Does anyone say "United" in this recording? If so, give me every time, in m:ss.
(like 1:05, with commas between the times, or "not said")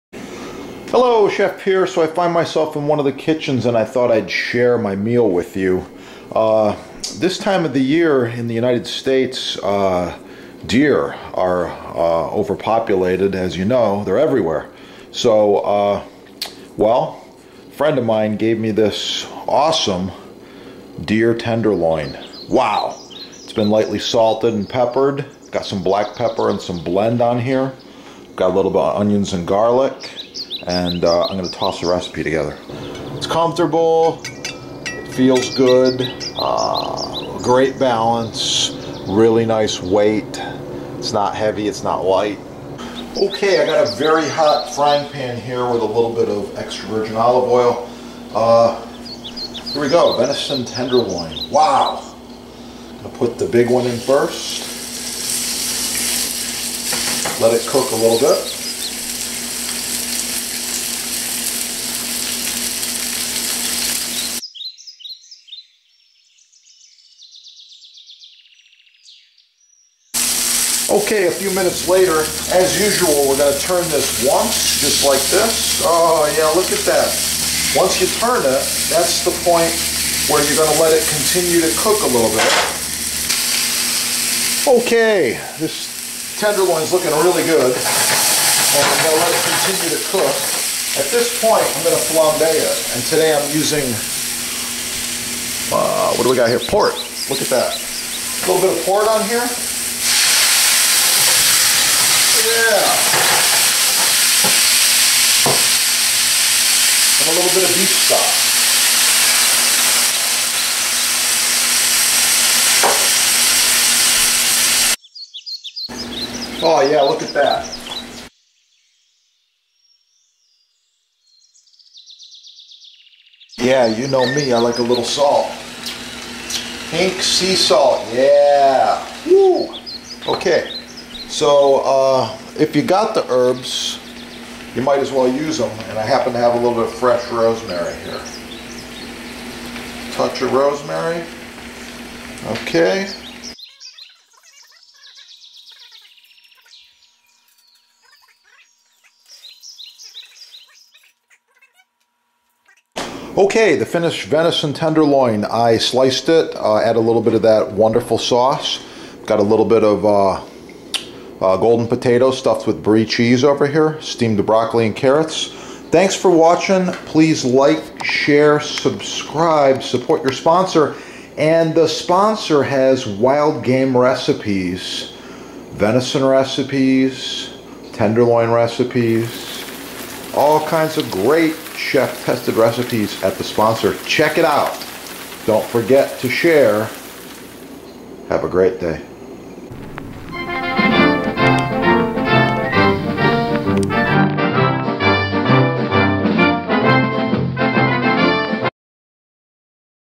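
0:08.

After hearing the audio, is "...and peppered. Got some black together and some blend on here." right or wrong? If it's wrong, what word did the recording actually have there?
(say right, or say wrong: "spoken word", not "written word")
wrong: "pepper", not "together".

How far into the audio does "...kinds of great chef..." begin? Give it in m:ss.
3:00.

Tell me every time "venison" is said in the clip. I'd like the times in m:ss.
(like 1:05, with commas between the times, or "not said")
0:50, 2:34, 2:55.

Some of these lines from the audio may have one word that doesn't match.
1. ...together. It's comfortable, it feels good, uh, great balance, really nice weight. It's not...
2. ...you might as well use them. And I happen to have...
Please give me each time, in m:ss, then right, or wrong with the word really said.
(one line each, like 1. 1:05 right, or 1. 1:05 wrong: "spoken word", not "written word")
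1. 0:32 right
2. 2:14 right.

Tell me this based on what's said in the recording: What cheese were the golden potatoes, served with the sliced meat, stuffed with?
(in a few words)
Brie.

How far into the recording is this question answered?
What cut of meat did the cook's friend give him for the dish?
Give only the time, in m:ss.
0:21.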